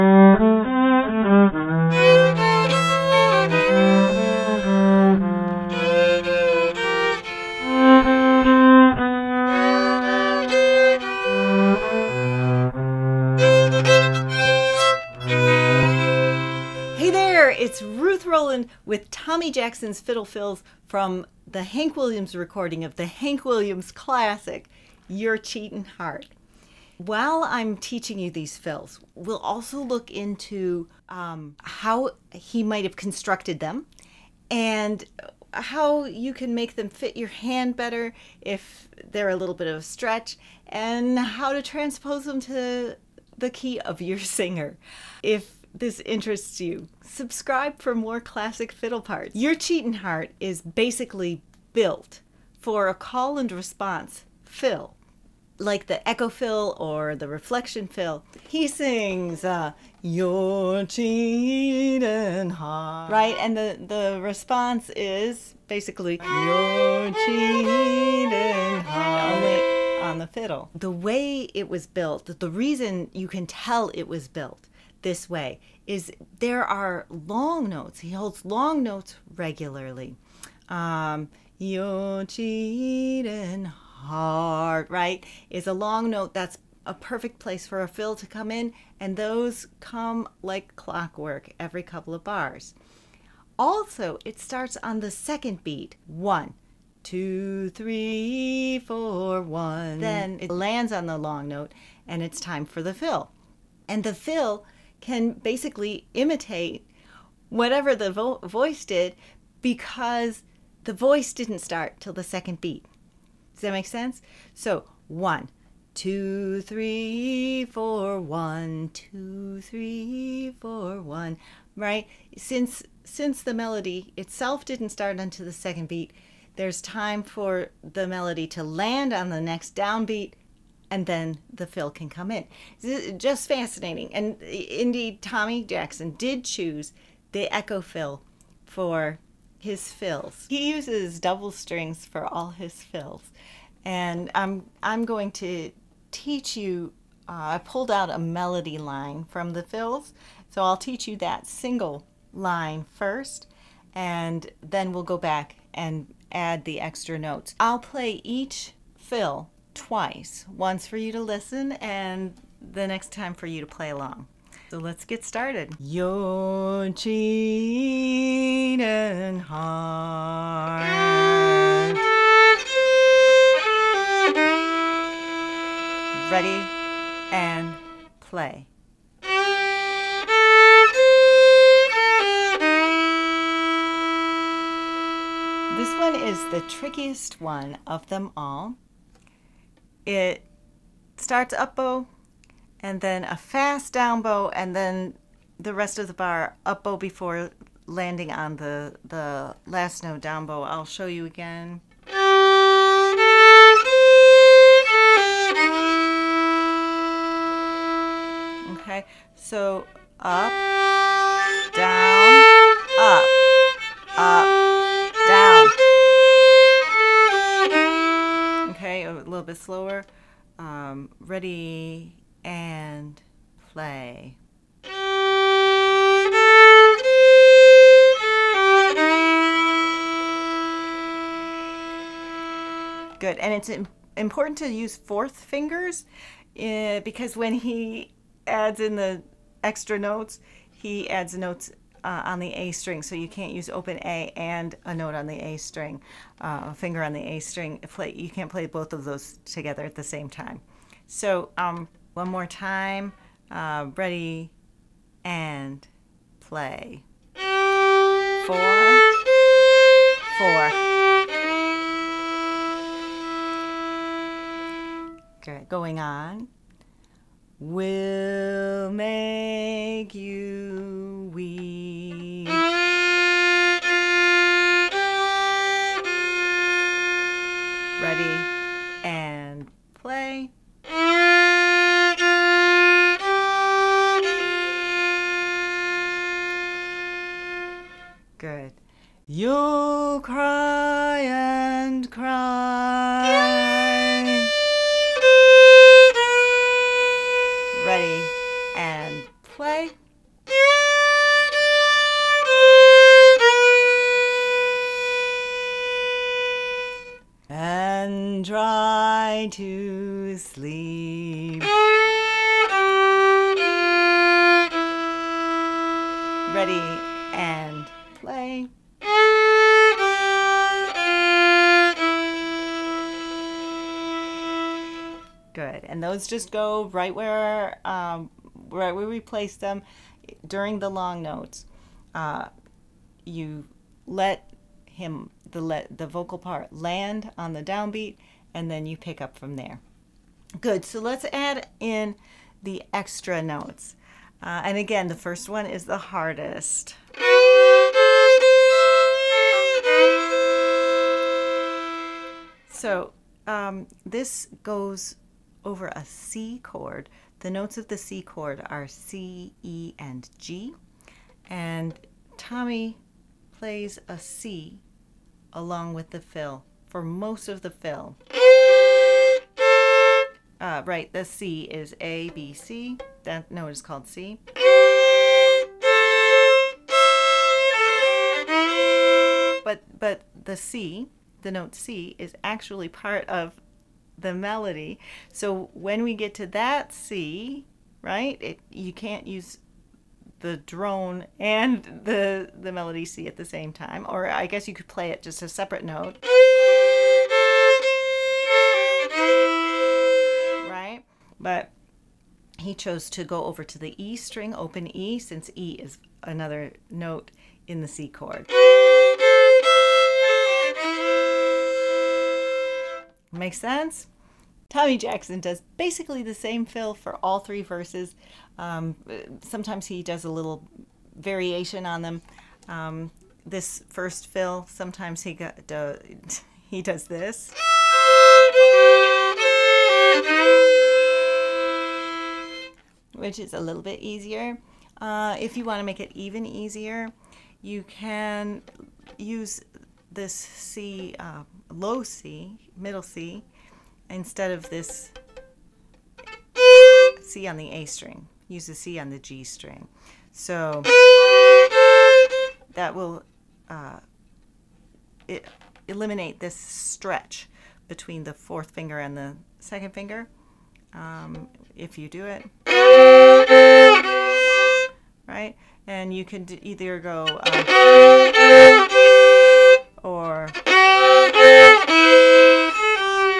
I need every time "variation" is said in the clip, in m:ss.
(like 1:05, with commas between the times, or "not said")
7:01.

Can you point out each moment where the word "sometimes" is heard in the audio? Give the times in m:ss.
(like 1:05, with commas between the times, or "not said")
6:59, 7:04.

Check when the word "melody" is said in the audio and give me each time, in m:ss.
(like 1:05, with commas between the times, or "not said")
2:03, 2:08, 2:28, 6:24, 6:32.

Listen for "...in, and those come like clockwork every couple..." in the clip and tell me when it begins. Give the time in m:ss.
1:28.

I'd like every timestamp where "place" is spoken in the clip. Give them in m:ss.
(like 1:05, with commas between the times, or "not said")
1:27, 5:29.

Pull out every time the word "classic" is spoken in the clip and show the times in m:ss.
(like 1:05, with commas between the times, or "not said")
0:23, 0:48.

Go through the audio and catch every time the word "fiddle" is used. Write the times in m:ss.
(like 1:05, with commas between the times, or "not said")
0:19, 0:48, 1:10.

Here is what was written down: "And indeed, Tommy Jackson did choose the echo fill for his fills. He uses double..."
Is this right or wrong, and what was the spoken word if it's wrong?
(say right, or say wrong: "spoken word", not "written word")
right.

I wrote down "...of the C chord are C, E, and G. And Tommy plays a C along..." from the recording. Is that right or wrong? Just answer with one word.
right.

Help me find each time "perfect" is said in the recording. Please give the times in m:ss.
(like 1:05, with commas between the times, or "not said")
1:26.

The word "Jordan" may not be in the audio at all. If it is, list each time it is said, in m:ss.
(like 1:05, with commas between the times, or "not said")
not said.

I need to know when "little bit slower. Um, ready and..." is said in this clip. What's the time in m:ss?
3:39.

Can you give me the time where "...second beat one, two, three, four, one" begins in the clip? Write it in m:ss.
1:35.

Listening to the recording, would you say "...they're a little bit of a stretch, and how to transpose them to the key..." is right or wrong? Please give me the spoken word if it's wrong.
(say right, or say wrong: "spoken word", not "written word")
right.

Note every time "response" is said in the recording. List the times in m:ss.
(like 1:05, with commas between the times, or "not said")
0:53, 1:04.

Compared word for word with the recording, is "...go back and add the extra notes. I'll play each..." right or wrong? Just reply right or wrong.
right.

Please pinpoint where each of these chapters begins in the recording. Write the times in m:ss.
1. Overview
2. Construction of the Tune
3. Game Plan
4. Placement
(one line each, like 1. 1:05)
1. 0:16
2. 0:49
3. 2:20
4. 5:25.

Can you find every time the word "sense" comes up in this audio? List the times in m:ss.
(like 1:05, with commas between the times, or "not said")
1:53, 6:53.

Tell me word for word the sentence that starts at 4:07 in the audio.
Play, you can't play both of those together at the same time.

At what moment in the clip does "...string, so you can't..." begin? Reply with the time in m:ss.
4:02.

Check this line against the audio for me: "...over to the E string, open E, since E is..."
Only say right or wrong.
right.